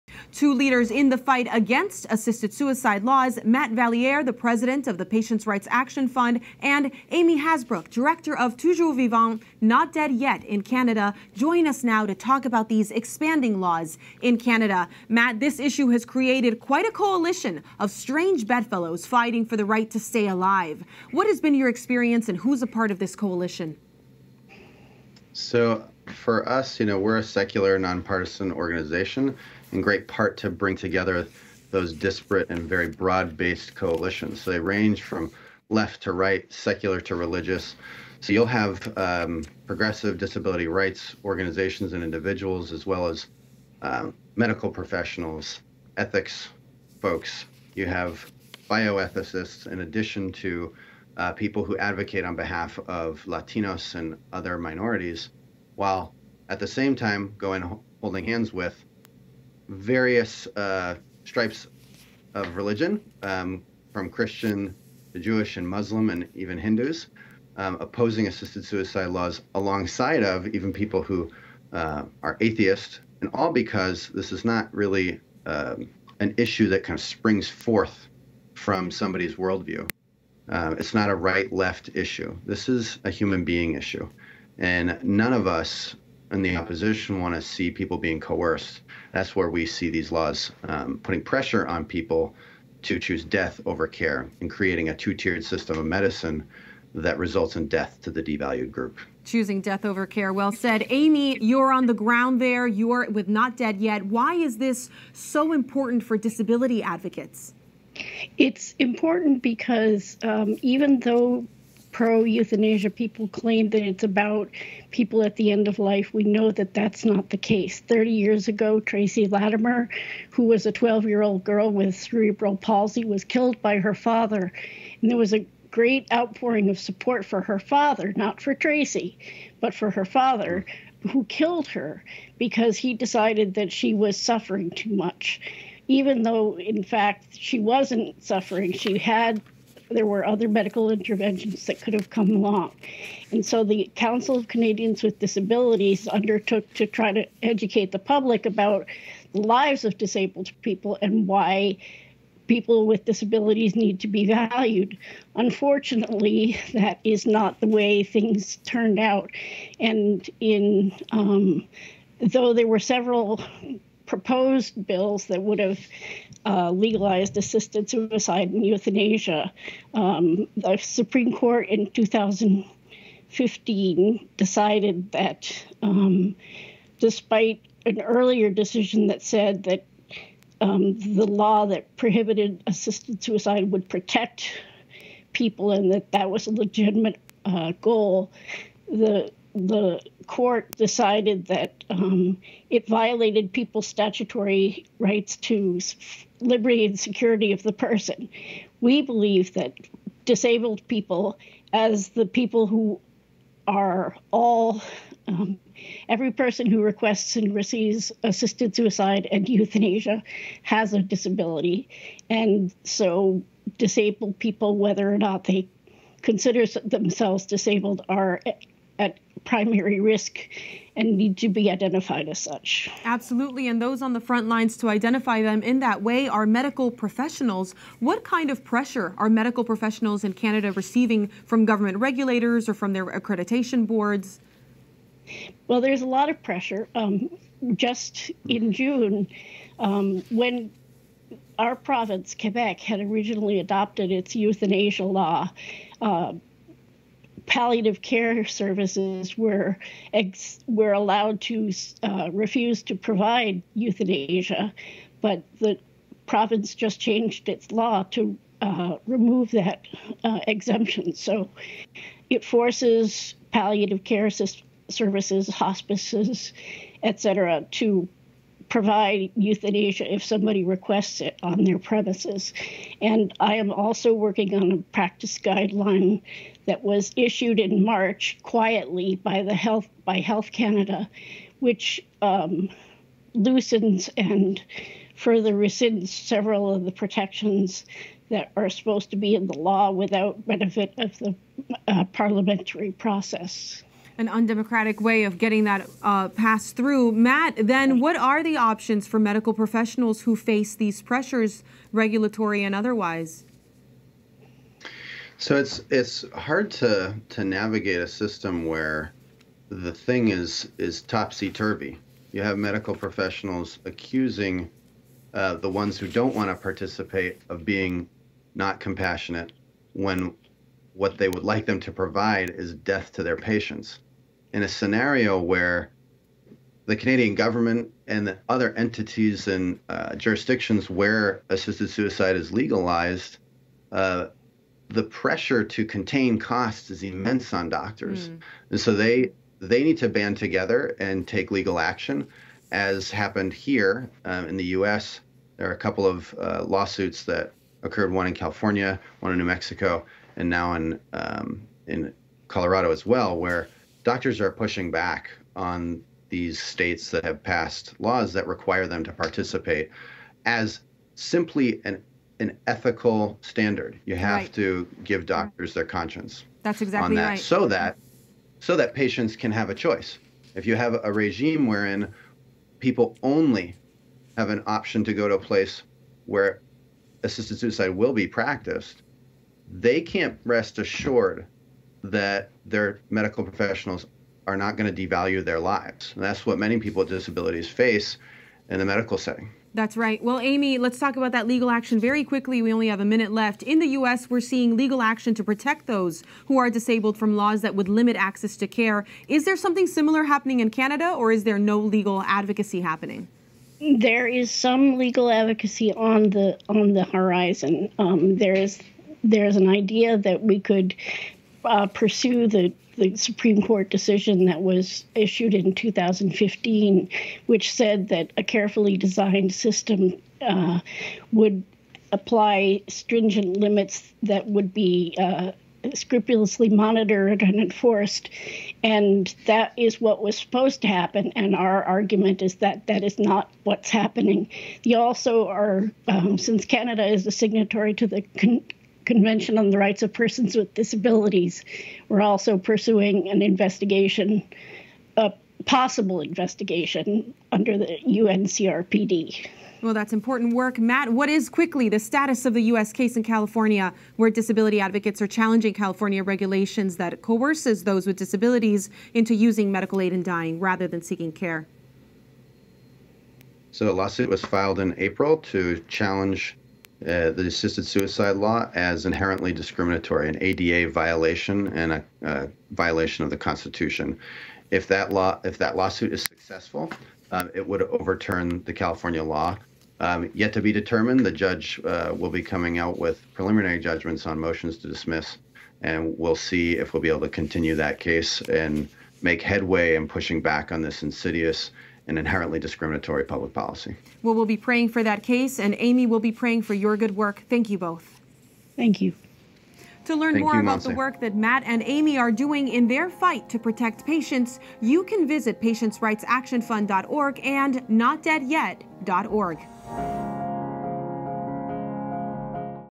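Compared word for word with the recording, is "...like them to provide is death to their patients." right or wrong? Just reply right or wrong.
right.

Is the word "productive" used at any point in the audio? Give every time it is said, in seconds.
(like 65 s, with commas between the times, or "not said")
not said.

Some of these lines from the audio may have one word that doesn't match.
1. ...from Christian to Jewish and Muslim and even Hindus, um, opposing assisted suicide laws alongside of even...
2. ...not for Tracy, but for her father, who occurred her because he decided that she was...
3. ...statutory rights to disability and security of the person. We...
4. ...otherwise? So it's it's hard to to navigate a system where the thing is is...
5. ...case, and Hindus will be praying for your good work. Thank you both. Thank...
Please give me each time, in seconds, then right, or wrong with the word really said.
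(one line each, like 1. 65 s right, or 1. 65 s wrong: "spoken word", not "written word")
1. 63 s right
2. 128 s wrong: "killed", not "occurred"
3. 193 s wrong: "liberty", not "disability"
4. 302 s right
5. 495 s wrong: "Amy", not "Hindus".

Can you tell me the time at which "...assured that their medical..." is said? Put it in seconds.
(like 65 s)
380 s.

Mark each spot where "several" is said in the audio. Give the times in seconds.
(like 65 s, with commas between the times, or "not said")
162 s, 286 s.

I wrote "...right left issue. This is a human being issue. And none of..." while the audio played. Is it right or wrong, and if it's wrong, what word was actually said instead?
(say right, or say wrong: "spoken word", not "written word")
right.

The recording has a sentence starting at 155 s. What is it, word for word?
Unfortunately, that is not the way things turned out.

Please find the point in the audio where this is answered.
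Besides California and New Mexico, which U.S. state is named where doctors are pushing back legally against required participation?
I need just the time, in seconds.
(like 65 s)
352 s.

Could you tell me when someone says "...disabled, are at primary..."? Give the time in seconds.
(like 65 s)
217 s.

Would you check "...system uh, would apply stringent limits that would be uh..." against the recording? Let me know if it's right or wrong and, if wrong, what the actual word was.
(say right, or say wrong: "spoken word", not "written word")
right.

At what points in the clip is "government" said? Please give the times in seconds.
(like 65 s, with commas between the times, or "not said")
231 s, 327 s.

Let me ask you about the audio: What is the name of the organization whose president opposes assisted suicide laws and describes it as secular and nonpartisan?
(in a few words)
Patients' Rights Action Fund.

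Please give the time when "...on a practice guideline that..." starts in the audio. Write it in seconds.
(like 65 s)
274 s.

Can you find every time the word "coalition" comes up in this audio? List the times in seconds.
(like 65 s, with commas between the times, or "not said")
16 s, 23 s, 33 s.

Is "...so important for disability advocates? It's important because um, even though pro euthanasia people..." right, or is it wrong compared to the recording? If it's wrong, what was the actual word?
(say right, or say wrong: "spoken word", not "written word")
right.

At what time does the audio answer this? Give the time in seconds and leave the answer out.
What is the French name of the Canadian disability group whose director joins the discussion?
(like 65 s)
8 s.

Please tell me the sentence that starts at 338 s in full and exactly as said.
and so they they need to band together and take legal action, as happened here um, in the U.S.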